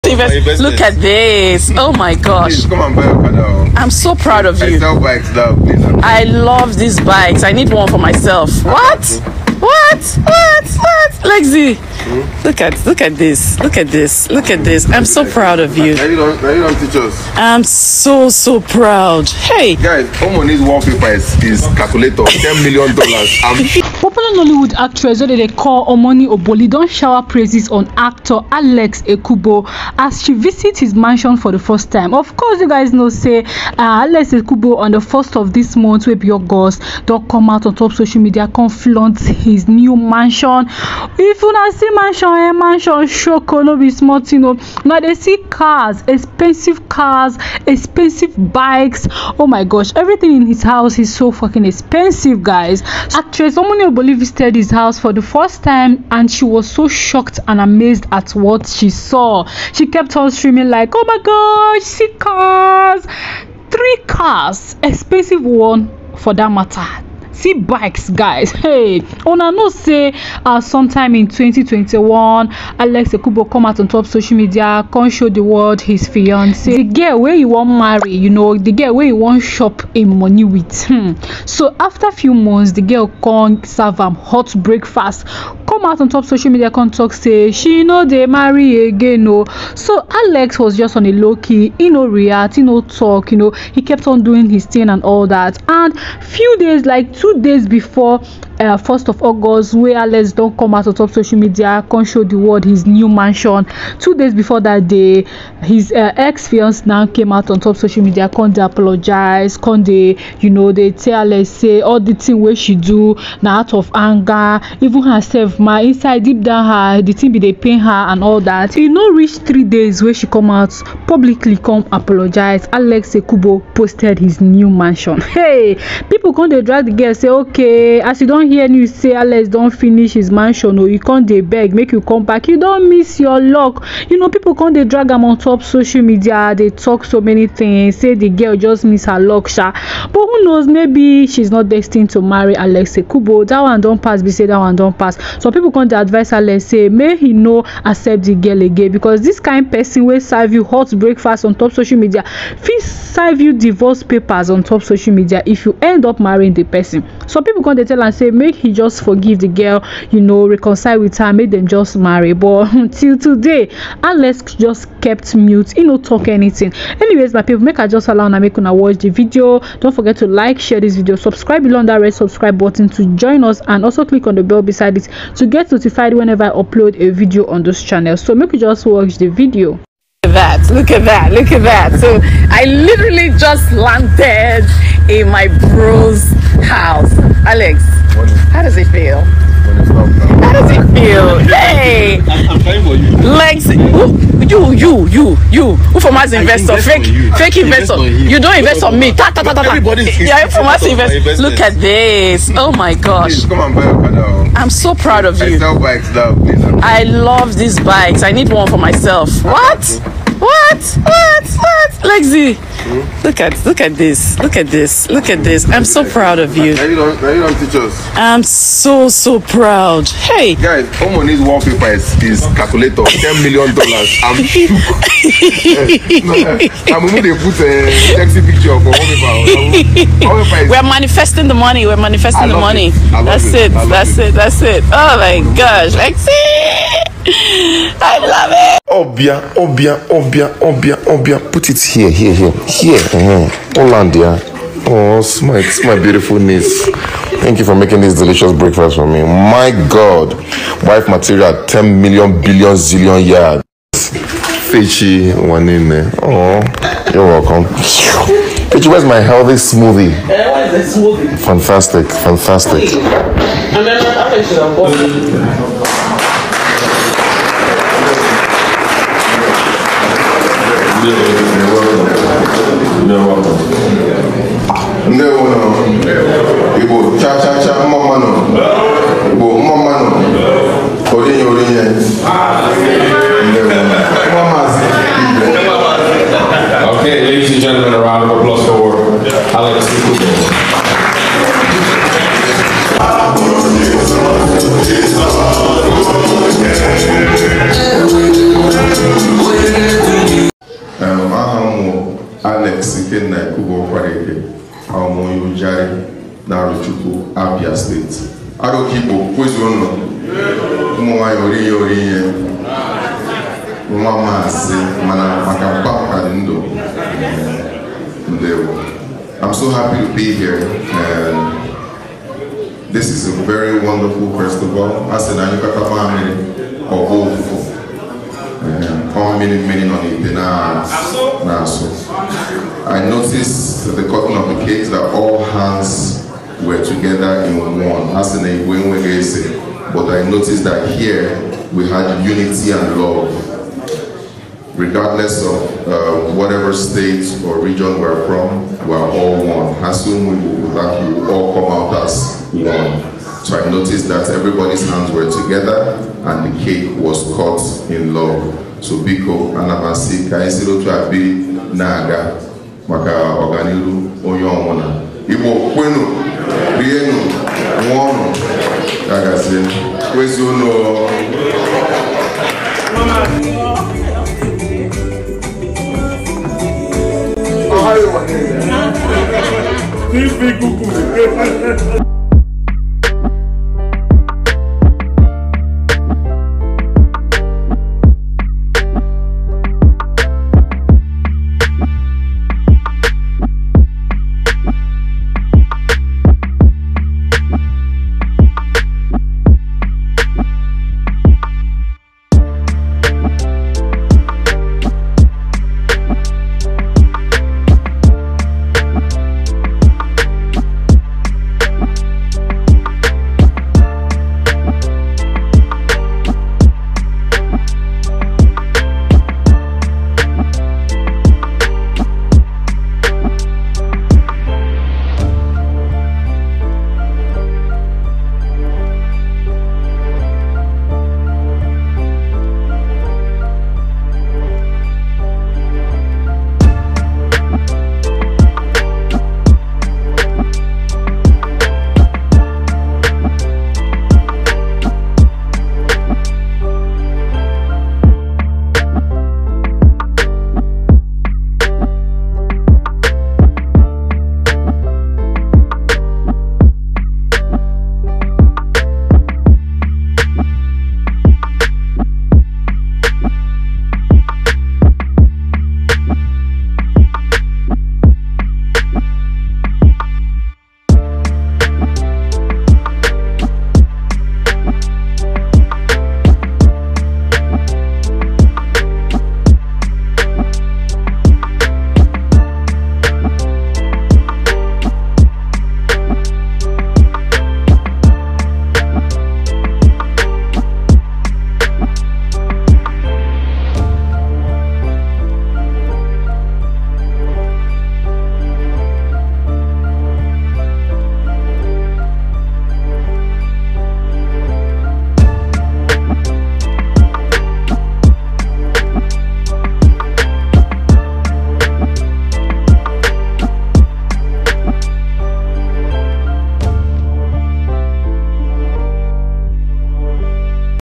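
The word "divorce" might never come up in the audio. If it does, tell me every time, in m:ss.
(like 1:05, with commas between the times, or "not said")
2:33.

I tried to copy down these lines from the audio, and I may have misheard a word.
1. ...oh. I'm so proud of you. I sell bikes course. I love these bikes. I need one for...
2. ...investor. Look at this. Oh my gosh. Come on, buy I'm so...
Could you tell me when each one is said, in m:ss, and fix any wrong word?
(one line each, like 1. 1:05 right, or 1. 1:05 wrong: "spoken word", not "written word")
1. 0:03 wrong: "please", not "course"
2. 3:20 right.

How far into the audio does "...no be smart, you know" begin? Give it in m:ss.
0:43.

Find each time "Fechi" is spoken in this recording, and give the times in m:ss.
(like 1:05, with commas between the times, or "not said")
4:13, 4:18.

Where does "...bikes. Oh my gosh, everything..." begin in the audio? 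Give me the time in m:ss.
0:48.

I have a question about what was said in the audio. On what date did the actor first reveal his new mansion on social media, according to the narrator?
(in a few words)
1st of August.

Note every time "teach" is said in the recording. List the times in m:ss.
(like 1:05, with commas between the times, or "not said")
0:16, 3:37.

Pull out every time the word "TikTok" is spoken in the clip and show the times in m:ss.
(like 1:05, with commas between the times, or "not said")
not said.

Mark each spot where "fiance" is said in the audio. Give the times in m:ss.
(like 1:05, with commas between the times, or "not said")
1:16, 1:46.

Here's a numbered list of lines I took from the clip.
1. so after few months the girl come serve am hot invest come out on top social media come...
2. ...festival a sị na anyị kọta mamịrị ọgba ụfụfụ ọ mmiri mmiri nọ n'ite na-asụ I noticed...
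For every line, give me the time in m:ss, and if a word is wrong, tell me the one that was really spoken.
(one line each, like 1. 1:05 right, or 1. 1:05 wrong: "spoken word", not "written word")
1. 1:21 wrong: "breakfast", not "invest"
2. 5:24 right.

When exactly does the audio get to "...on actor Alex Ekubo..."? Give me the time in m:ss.
0:27.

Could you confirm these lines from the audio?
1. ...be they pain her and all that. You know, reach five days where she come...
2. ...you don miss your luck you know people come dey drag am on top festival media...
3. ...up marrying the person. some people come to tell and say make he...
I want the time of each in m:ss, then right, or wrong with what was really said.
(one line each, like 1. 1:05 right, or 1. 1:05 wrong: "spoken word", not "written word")
1. 1:57 wrong: "three", not "five"
2. 2:12 wrong: "social", not "festival"
3. 2:36 right.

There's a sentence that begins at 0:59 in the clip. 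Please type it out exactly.
She kept on screaming like, oh my gosh, see cars!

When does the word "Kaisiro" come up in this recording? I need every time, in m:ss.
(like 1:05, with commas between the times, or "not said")
6:00.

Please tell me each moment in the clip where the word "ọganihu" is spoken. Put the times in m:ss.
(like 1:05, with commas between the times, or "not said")
6:03.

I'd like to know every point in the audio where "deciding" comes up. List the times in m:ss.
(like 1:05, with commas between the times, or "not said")
not said.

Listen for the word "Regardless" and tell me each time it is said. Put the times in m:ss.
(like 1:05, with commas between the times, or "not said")
5:44.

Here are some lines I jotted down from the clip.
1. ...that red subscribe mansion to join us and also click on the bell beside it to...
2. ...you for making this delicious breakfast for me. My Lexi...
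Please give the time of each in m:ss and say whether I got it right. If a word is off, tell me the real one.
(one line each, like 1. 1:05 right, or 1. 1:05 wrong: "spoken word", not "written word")
1. 2:51 wrong: "button", not "mansion"
2. 4:07 wrong: "God", not "Lexi".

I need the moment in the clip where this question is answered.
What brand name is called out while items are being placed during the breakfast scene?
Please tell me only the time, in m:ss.
4:03.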